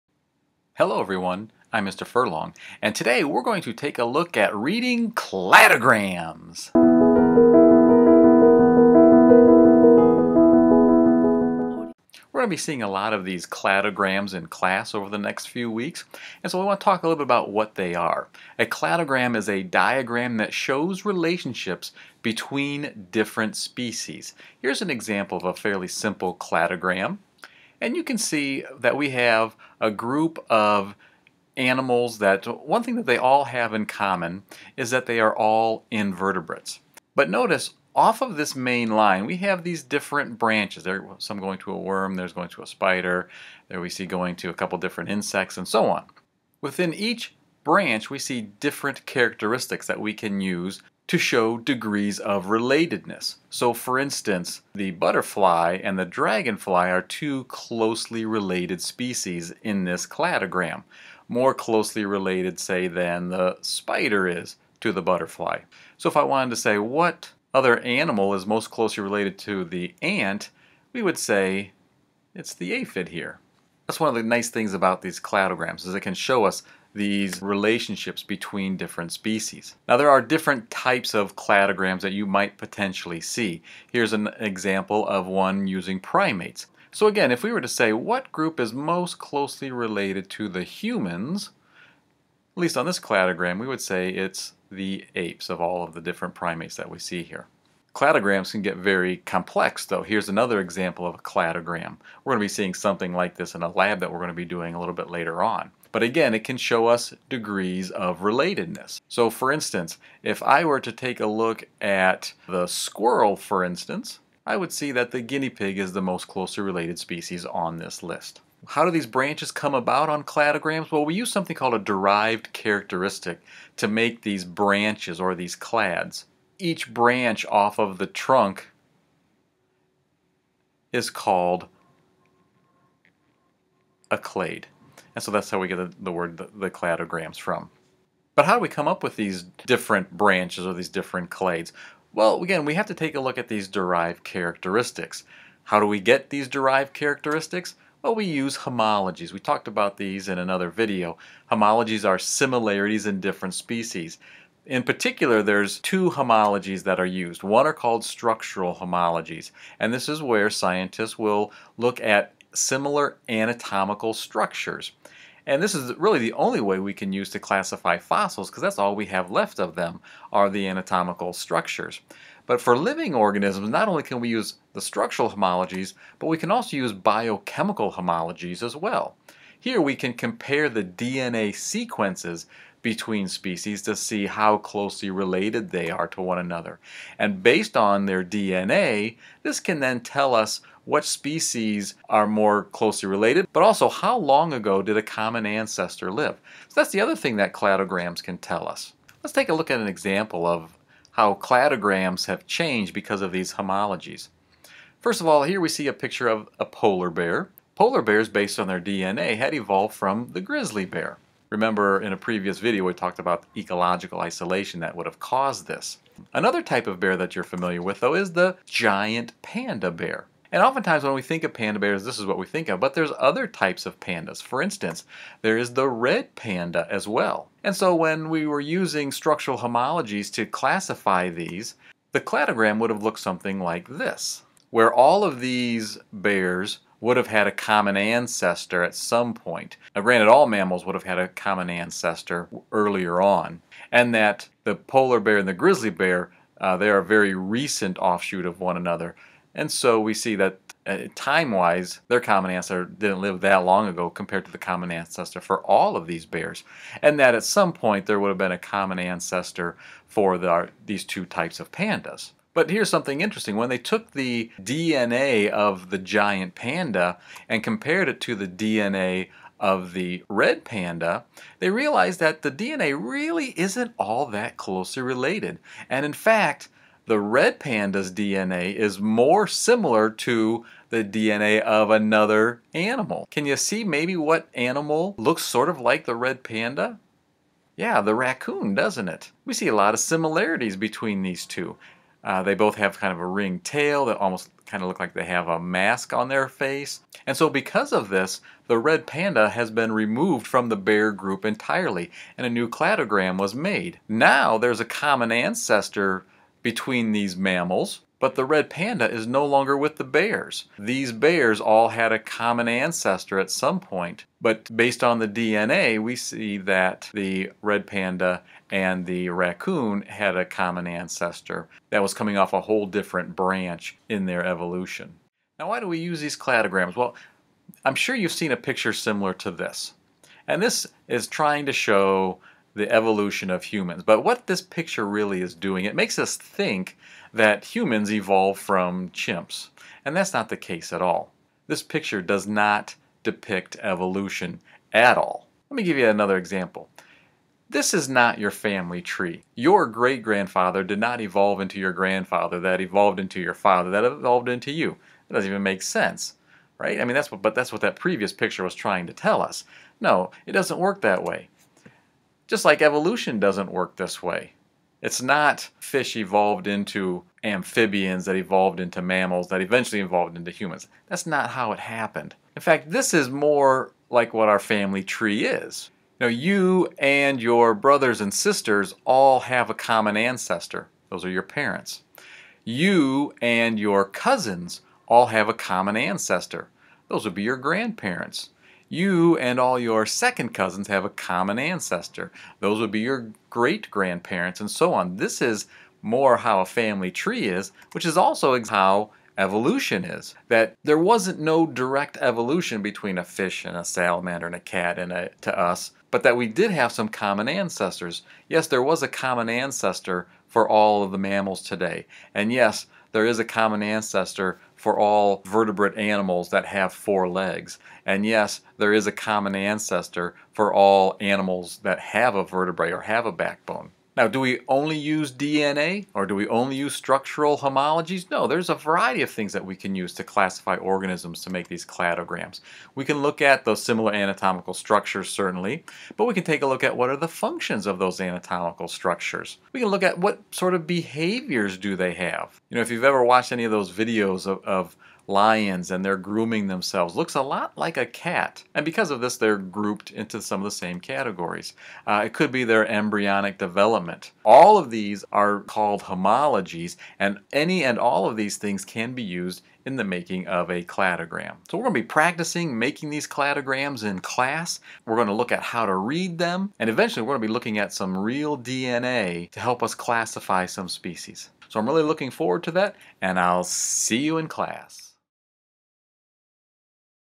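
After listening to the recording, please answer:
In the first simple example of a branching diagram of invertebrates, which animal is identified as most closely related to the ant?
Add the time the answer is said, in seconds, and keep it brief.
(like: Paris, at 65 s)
aphid, at 72 s.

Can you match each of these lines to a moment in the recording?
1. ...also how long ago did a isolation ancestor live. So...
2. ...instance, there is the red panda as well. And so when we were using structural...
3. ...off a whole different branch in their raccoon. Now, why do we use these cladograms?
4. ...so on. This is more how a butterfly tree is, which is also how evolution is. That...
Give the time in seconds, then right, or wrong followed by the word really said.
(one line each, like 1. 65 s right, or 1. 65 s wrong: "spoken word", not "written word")
1. 193 s wrong: "common", not "isolation"
2. 224 s right
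3. 322 s wrong: "evolution", not "raccoon"
4. 394 s wrong: "family", not "butterfly".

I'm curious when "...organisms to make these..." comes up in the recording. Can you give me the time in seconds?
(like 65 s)
430 s.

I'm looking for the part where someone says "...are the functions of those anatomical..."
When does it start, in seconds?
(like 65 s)
437 s.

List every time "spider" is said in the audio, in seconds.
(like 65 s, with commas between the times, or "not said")
42 s, 63 s.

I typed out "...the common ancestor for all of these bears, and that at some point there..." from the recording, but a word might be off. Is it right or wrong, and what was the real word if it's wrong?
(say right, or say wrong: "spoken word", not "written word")
right.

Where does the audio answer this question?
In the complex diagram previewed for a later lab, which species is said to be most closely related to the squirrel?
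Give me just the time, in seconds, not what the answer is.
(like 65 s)
115 s.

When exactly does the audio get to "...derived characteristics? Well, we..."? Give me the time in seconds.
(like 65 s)
146 s.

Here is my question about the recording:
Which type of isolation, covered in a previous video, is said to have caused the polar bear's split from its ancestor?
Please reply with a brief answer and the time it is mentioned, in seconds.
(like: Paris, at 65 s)
ecological isolation, at 213 s.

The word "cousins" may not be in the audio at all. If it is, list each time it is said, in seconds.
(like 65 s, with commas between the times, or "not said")
384 s, 390 s.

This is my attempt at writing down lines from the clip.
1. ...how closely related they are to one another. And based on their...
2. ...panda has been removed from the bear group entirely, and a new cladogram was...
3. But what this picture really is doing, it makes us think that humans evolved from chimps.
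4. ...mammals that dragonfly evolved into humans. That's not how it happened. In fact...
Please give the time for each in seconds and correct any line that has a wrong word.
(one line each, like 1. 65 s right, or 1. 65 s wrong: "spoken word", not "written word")
1. 184 s right
2. 299 s right
3. 334 s right
4. 369 s wrong: "eventually", not "dragonfly".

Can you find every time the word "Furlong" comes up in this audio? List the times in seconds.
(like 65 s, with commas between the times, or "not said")
2 s.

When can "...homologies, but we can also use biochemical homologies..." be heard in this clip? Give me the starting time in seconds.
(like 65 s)
175 s.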